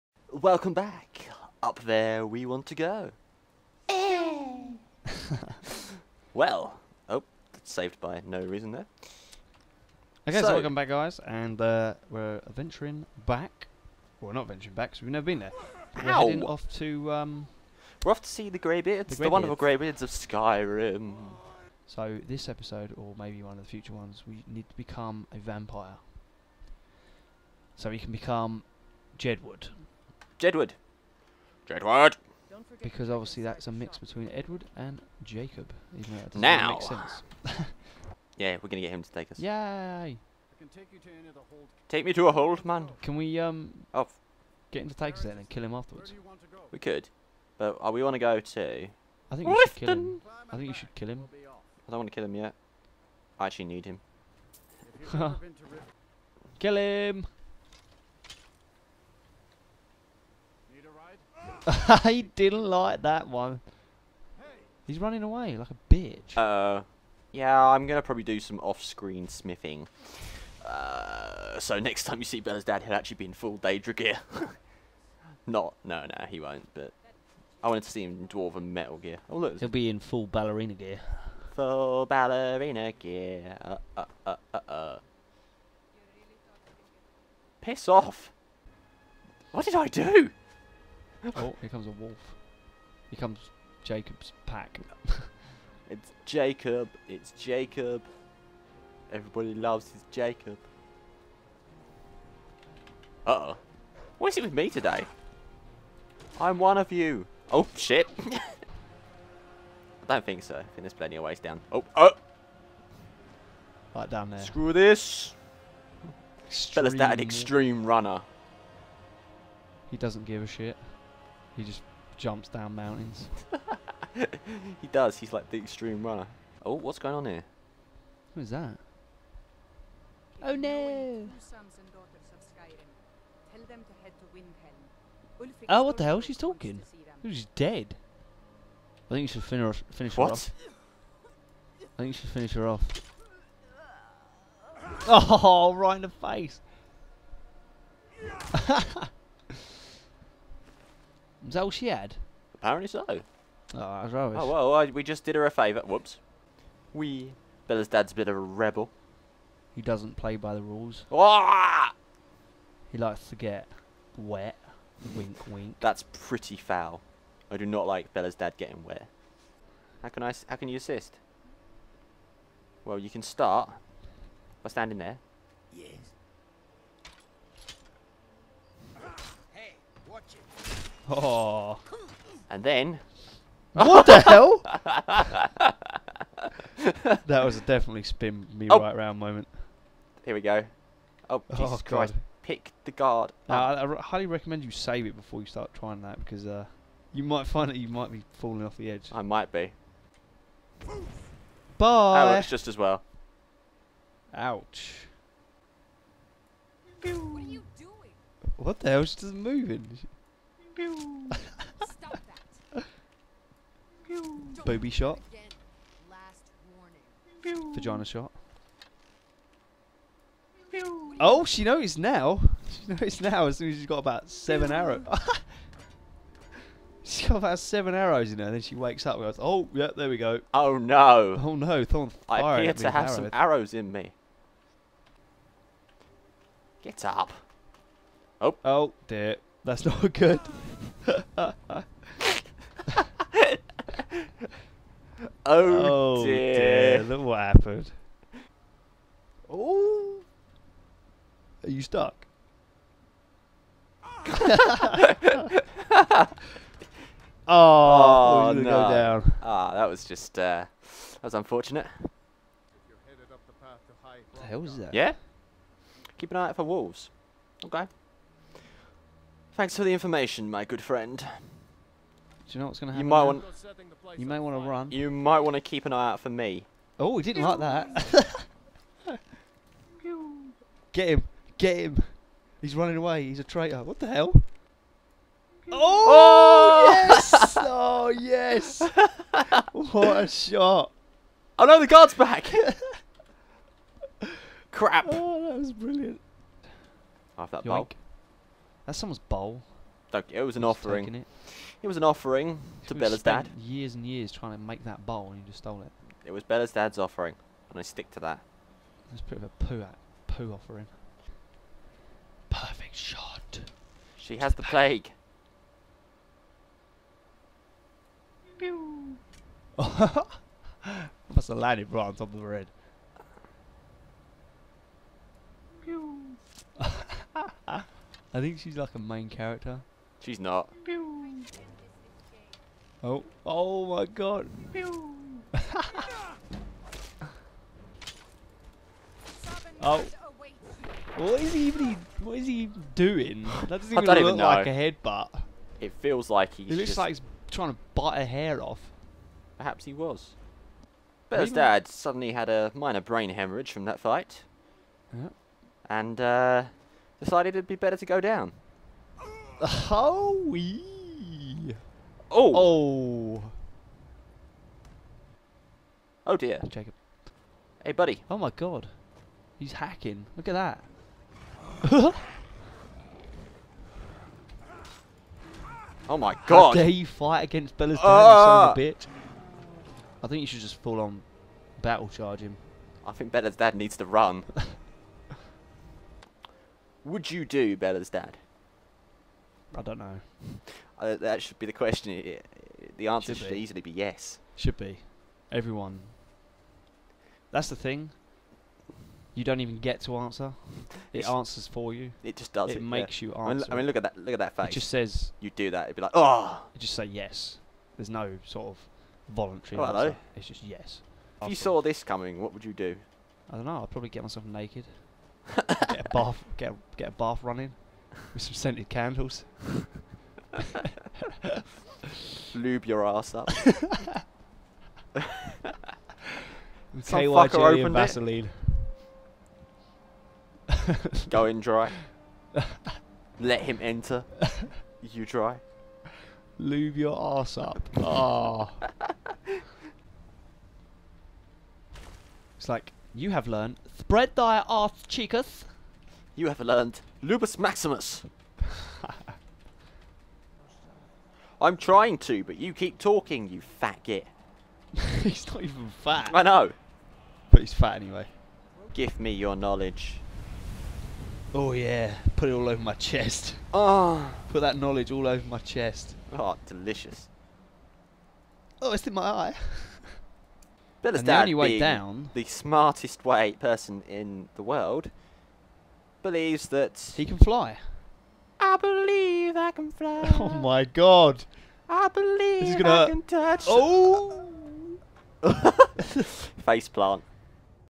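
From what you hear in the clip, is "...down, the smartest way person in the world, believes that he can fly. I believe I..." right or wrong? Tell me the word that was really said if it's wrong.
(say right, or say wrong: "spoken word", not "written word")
right.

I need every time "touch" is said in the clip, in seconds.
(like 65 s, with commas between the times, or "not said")
483 s.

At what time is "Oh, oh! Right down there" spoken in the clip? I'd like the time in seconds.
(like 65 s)
111 s.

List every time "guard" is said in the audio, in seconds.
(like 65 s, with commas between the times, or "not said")
192 s, 291 s.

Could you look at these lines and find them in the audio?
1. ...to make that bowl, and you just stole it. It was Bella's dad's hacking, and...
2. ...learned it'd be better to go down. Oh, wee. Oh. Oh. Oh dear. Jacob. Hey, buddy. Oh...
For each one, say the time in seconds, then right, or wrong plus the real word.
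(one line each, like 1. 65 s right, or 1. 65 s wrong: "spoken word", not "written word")
1. 304 s wrong: "offering", not "hacking"
2. 357 s wrong: "decided", not "learned".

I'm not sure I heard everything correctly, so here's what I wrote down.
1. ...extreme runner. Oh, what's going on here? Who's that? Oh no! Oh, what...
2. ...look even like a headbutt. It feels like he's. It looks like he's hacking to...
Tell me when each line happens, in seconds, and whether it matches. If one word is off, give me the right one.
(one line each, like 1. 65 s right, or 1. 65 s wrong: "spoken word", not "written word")
1. 125 s right
2. 344 s wrong: "trying", not "hacking".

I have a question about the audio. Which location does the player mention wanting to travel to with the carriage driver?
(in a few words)
Lifton.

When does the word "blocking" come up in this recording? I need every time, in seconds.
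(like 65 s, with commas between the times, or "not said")
not said.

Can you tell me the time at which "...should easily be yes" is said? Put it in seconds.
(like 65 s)
393 s.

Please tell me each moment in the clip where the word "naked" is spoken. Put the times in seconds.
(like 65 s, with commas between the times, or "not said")
414 s.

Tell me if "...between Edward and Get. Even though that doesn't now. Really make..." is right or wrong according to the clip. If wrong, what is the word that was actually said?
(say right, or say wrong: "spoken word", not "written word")
wrong: "Jacob", not "Get".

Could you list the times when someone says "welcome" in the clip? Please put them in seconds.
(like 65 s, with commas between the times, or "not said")
0 s, 10 s.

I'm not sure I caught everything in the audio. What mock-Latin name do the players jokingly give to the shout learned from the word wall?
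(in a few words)
Lupus maximus.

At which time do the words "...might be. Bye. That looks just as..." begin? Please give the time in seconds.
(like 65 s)
199 s.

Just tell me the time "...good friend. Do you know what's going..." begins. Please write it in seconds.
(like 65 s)
270 s.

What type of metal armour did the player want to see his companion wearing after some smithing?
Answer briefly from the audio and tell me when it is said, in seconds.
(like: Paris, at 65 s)
Dwarven, at 78 s.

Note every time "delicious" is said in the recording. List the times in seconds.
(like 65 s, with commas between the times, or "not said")
466 s.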